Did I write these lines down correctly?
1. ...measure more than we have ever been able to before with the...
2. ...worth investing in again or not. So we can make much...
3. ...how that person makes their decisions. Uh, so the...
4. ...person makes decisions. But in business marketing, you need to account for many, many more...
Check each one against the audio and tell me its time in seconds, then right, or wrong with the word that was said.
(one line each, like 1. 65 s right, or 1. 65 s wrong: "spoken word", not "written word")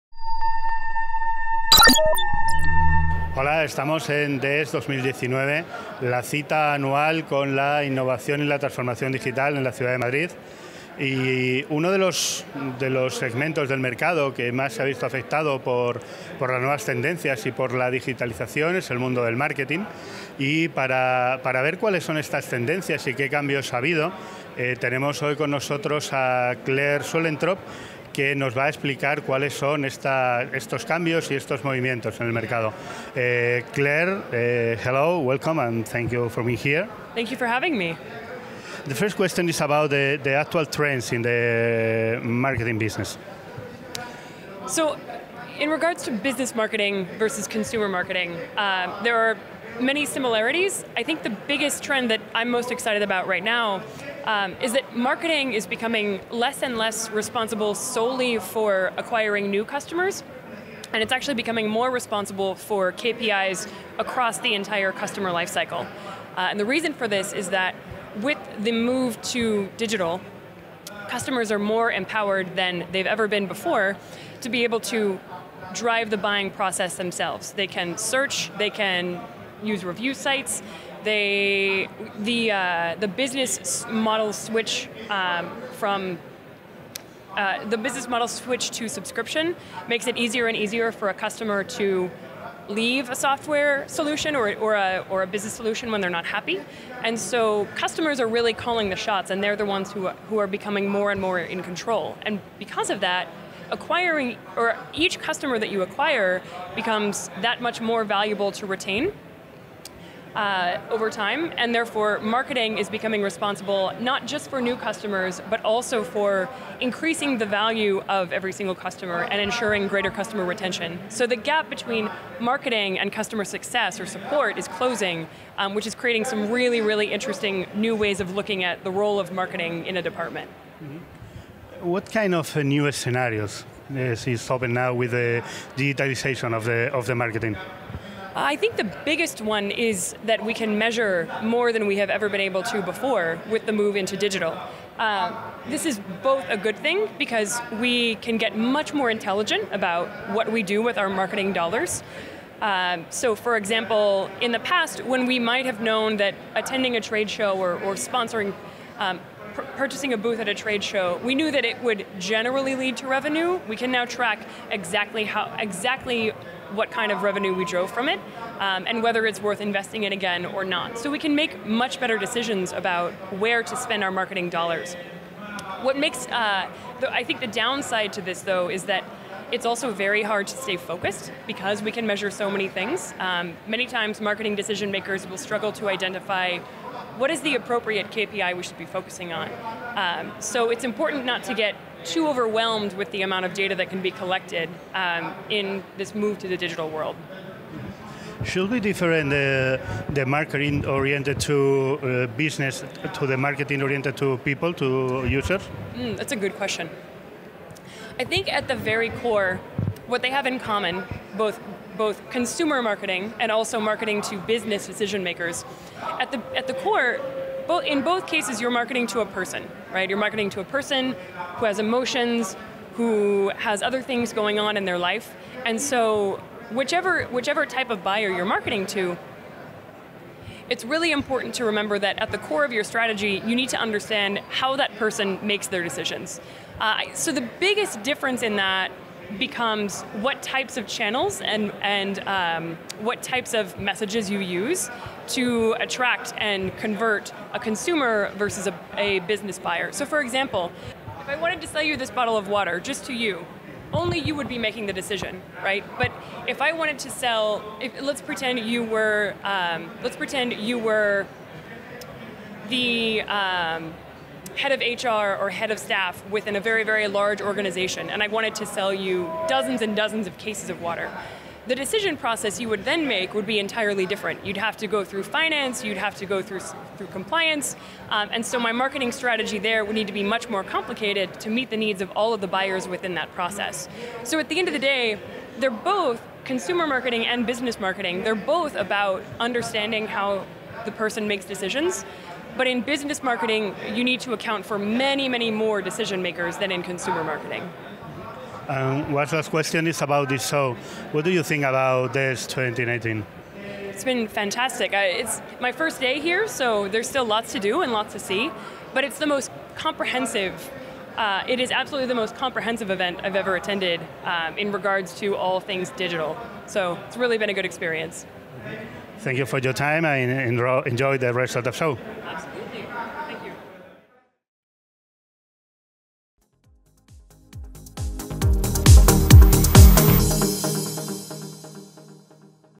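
1. 140 s right
2. 169 s right
3. 234 s right
4. 290 s right.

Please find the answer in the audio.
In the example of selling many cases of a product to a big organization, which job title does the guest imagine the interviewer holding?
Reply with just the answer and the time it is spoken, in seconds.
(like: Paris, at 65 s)
Head of HR, at 264 s.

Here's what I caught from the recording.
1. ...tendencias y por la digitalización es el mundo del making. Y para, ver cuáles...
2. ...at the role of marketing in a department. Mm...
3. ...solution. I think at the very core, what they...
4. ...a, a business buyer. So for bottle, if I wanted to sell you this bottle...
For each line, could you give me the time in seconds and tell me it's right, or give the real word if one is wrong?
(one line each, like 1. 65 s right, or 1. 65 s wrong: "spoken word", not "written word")
1. 16 s wrong: "marketing", not "making"
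2. 128 s right
3. 206 s wrong: "question", not "solution"
4. 248 s wrong: "example", not "bottle".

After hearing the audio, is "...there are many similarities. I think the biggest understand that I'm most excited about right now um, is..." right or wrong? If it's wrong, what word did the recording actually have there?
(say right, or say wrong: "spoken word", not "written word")
wrong: "trend", not "understand".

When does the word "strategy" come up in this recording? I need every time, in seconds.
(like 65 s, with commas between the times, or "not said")
232 s, 279 s.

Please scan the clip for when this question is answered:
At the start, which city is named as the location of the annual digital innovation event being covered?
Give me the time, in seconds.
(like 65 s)
9 s.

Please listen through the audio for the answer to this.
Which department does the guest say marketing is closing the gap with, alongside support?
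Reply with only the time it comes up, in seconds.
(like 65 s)
123 s.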